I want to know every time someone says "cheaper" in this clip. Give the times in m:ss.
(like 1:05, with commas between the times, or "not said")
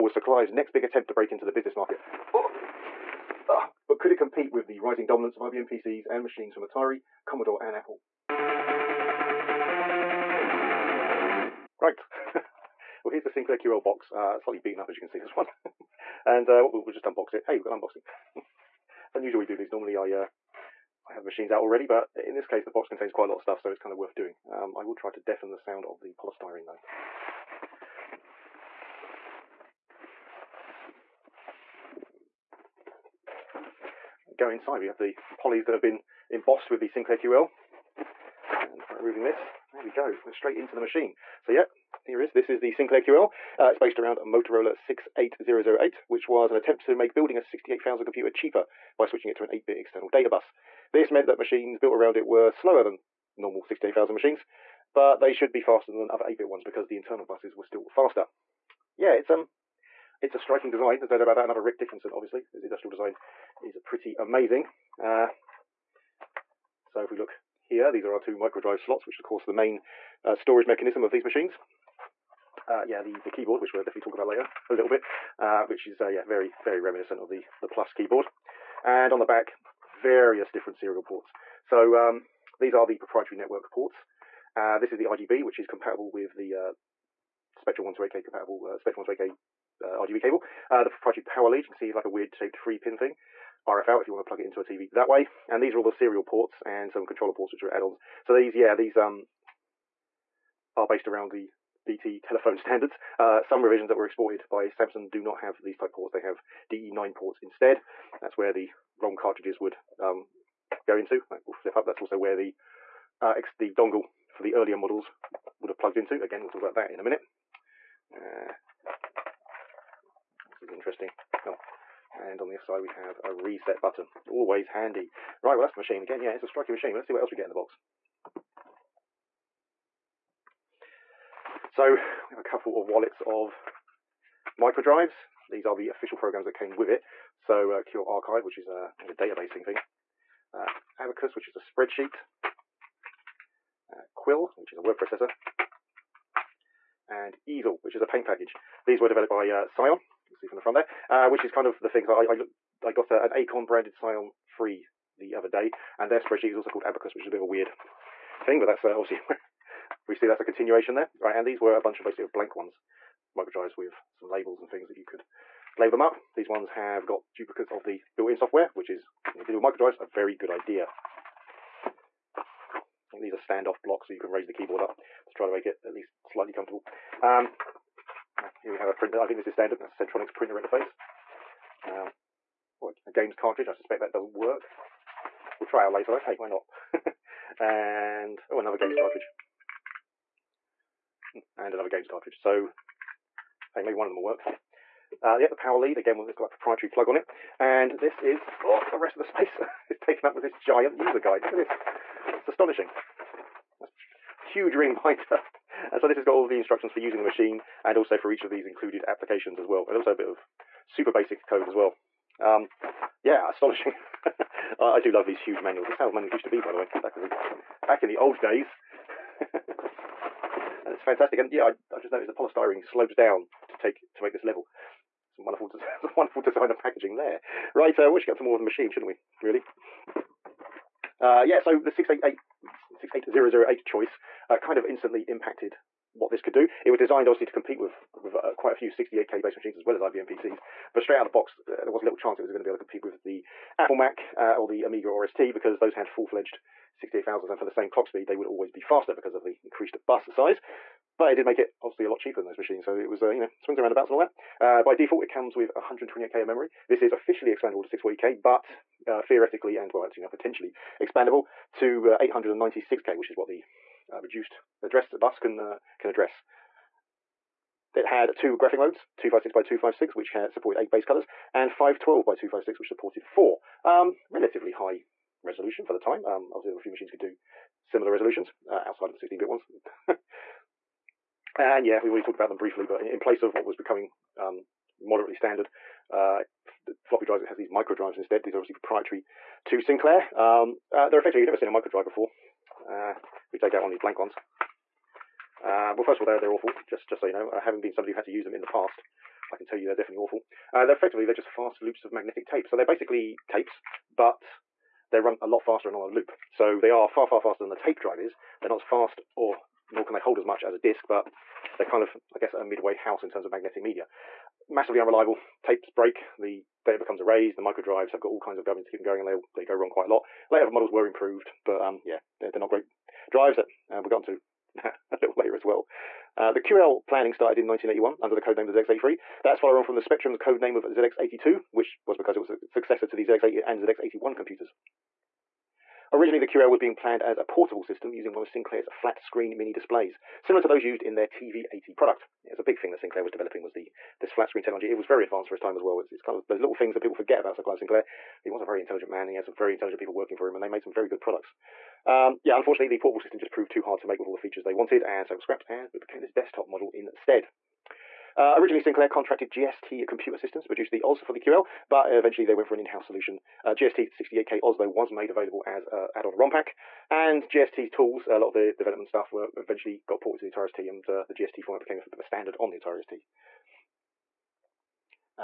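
0:48, 4:12.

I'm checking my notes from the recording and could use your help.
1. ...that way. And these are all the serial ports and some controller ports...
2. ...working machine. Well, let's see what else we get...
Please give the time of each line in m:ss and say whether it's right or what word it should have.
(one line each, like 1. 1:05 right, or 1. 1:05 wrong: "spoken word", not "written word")
1. 1:34 right
2. 2:06 wrong: "striking", not "working".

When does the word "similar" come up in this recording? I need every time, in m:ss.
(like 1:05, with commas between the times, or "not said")
4:37, 5:40.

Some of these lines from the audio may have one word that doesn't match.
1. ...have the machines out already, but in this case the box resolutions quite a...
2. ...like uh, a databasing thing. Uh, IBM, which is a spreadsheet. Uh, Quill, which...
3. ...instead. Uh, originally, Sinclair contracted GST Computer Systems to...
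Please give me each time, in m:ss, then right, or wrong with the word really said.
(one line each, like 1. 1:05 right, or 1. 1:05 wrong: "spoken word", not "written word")
1. 0:21 wrong: "contains", not "resolutions"
2. 2:18 wrong: "Abacus", not "IBM"
3. 5:56 right.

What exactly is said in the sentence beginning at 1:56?
Again, we'll talk about that in a minute.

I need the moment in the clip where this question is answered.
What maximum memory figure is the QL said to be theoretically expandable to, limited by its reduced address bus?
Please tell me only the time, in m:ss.
4:22.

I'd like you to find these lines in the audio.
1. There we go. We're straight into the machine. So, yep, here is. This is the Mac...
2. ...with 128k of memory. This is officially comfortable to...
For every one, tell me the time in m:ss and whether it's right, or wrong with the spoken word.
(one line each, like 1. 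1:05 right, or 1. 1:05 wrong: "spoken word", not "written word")
1. 0:39 wrong: "Sinclair", not "Mac"
2. 4:15 wrong: "expandable", not "comfortable".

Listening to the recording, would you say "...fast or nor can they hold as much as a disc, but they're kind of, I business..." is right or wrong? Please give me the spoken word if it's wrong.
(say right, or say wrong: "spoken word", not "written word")
wrong: "guess", not "business".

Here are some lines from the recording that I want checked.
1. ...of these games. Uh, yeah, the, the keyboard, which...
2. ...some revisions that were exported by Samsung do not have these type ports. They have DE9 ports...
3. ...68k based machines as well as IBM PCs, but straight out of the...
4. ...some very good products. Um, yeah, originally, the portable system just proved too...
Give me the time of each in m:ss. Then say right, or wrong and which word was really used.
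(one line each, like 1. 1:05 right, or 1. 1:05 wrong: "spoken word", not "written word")
1. 1:11 wrong: "machines", not "games"
2. 1:43 right
3. 3:58 right
4. 5:50 wrong: "unfortunately", not "originally".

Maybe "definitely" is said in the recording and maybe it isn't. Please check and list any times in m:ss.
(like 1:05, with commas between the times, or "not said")
1:13, 4:59.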